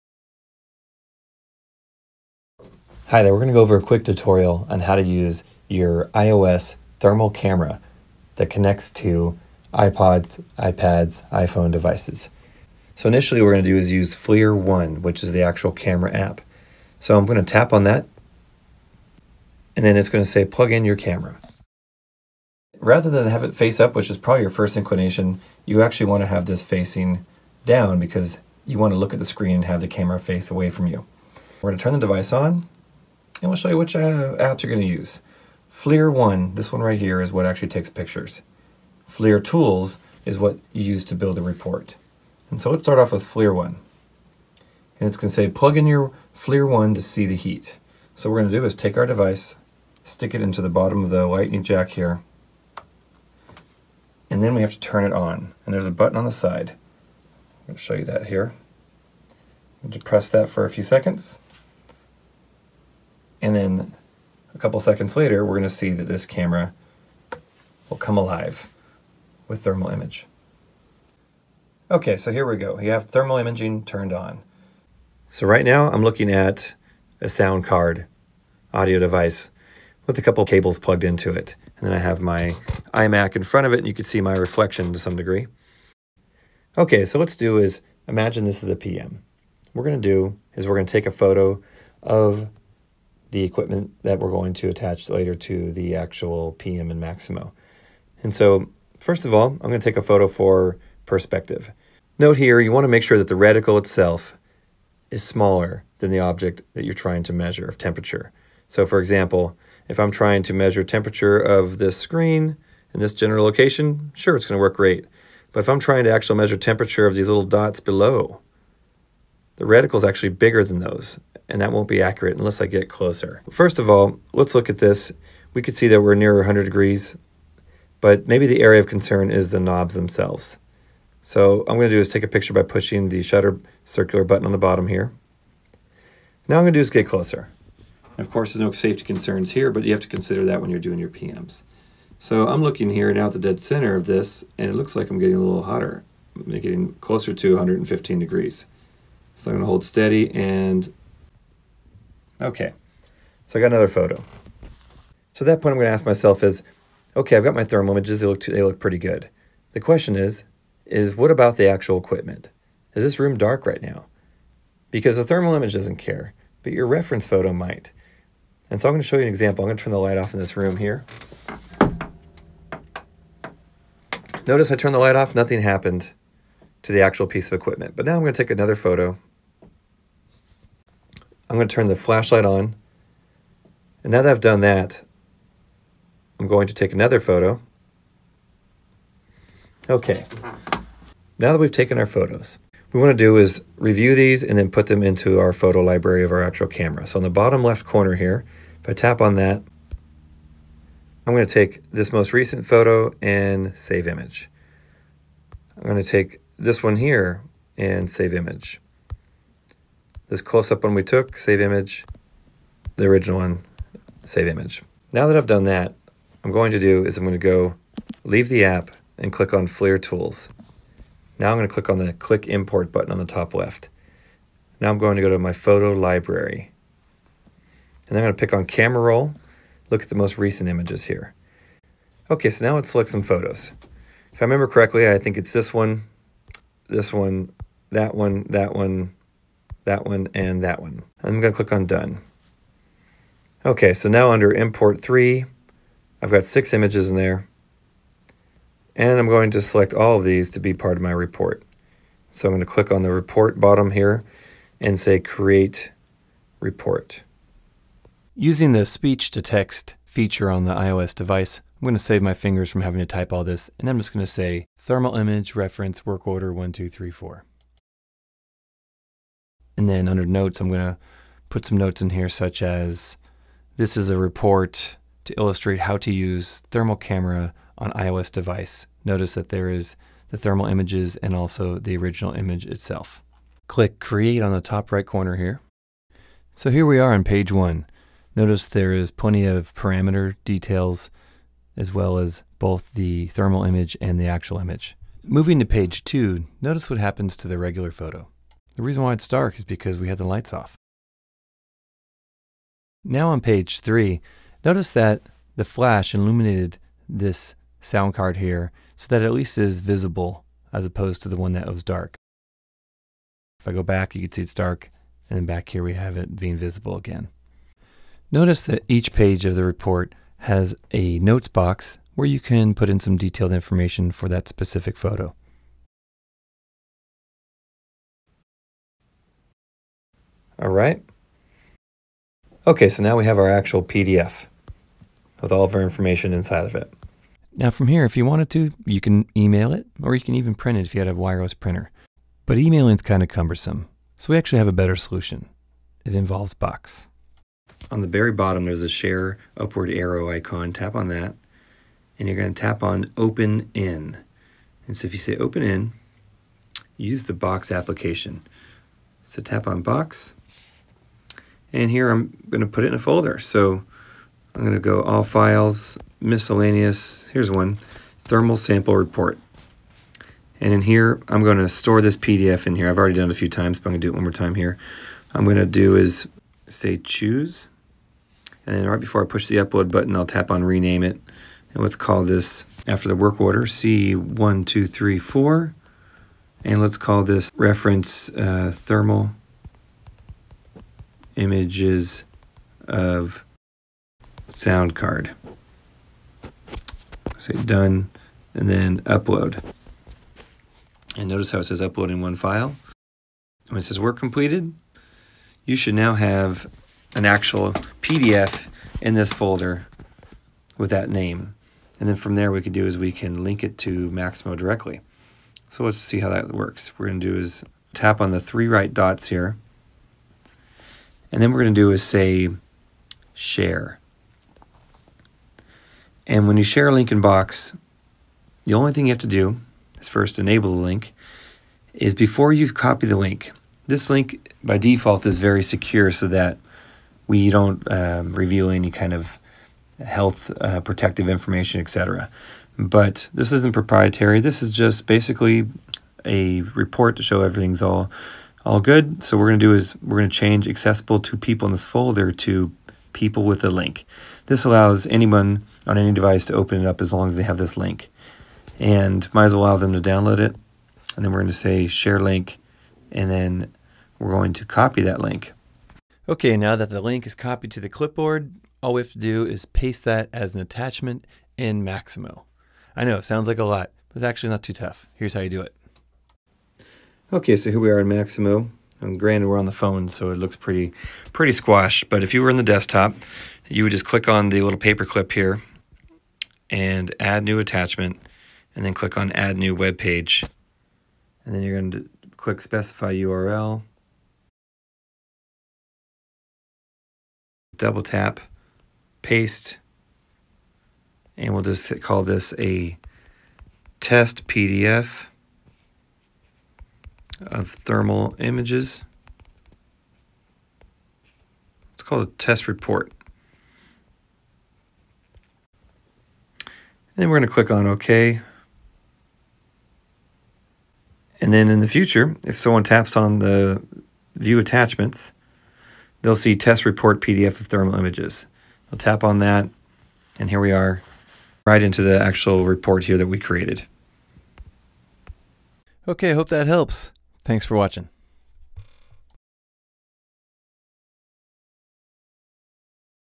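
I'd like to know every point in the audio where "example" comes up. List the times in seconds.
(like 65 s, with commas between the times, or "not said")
108 s, 169 s.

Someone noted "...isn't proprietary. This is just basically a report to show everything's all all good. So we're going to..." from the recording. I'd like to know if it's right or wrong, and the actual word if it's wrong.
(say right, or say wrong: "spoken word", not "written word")
right.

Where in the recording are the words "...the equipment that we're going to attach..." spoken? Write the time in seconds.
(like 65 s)
93 s.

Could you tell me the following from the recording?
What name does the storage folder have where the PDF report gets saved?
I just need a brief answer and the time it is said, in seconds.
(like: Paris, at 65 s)
Thermal Sample Report, at 368 s.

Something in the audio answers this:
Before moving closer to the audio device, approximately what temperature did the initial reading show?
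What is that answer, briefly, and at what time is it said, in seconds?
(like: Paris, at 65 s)
100 degrees, at 126 s.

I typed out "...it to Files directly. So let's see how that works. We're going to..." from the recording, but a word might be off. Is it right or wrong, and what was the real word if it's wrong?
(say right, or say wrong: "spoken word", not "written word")
wrong: "Maximo", not "Files".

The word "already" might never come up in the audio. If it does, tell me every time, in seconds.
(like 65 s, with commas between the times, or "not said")
372 s.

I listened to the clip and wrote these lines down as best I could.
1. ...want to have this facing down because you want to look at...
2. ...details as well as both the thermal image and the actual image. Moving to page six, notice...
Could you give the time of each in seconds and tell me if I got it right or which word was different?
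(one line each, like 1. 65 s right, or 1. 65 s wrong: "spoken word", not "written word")
1. 26 s right
2. 290 s wrong: "two", not "six".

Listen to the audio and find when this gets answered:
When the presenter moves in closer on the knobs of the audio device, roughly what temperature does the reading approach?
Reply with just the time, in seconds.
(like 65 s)
147 s.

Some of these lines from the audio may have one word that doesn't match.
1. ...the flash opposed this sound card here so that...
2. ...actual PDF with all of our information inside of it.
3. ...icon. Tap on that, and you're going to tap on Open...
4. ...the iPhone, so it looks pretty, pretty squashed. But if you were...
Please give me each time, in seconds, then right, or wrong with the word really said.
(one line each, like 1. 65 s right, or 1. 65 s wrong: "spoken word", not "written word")
1. 305 s wrong: "illuminated", not "opposed"
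2. 333 s right
3. 350 s right
4. 479 s wrong: "phone", not "iPhone".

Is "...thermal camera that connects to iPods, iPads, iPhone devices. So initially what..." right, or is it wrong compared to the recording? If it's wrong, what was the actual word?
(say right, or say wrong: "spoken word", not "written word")
right.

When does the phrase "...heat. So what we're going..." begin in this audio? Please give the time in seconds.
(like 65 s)
47 s.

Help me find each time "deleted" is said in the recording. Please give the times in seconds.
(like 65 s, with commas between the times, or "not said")
not said.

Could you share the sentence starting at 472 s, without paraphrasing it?
I know, it sounds like a lot, but it's actually not too tough.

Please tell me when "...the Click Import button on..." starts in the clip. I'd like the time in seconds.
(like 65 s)
221 s.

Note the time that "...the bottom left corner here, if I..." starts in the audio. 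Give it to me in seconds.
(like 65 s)
197 s.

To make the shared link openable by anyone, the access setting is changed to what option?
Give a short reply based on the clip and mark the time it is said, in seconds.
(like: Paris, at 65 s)
people with the link, at 453 s.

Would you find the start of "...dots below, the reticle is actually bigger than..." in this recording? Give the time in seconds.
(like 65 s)
117 s.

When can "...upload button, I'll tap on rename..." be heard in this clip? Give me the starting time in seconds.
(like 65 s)
379 s.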